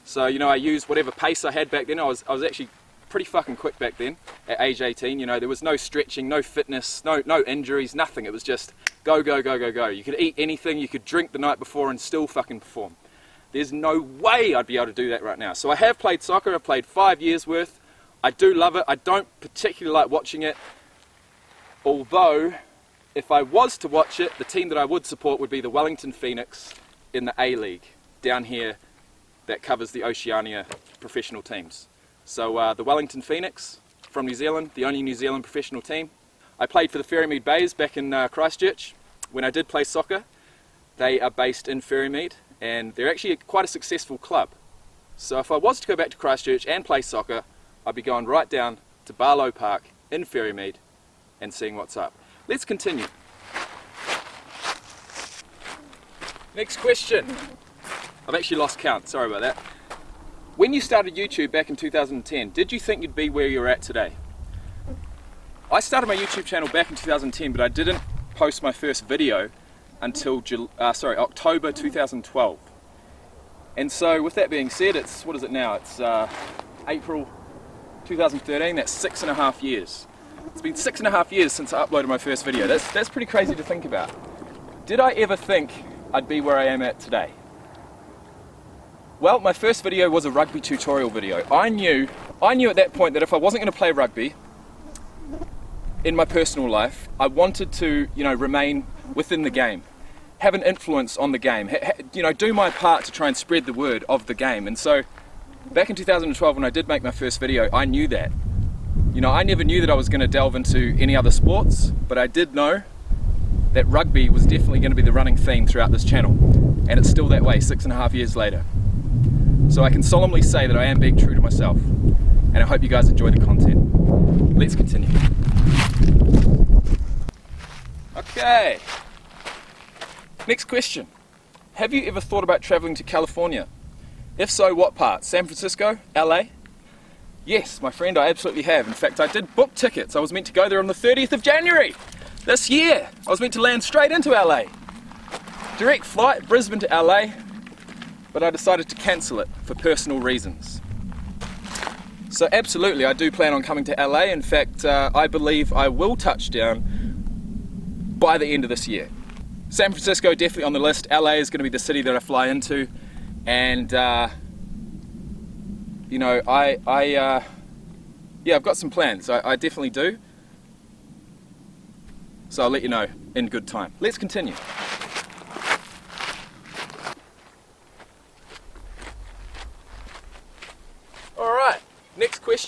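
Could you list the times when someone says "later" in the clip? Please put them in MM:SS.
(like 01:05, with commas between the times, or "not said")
01:58.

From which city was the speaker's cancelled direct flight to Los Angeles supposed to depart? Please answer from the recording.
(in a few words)
Brisbane.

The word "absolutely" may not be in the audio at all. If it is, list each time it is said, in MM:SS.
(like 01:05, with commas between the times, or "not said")
02:18, 02:32.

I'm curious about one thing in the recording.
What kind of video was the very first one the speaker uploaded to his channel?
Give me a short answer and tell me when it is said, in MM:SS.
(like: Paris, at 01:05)
Rugby tutorial, at 01:30.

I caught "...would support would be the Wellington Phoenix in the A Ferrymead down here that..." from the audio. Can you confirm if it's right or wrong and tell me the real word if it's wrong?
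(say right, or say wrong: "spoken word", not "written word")
wrong: "League", not "Ferrymead".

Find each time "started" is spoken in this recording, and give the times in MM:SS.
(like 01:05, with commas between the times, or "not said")
01:00, 01:05.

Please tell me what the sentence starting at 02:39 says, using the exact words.
San Francisco definitely on the list.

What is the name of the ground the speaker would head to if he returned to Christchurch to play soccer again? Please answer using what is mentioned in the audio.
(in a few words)
Barlow Park.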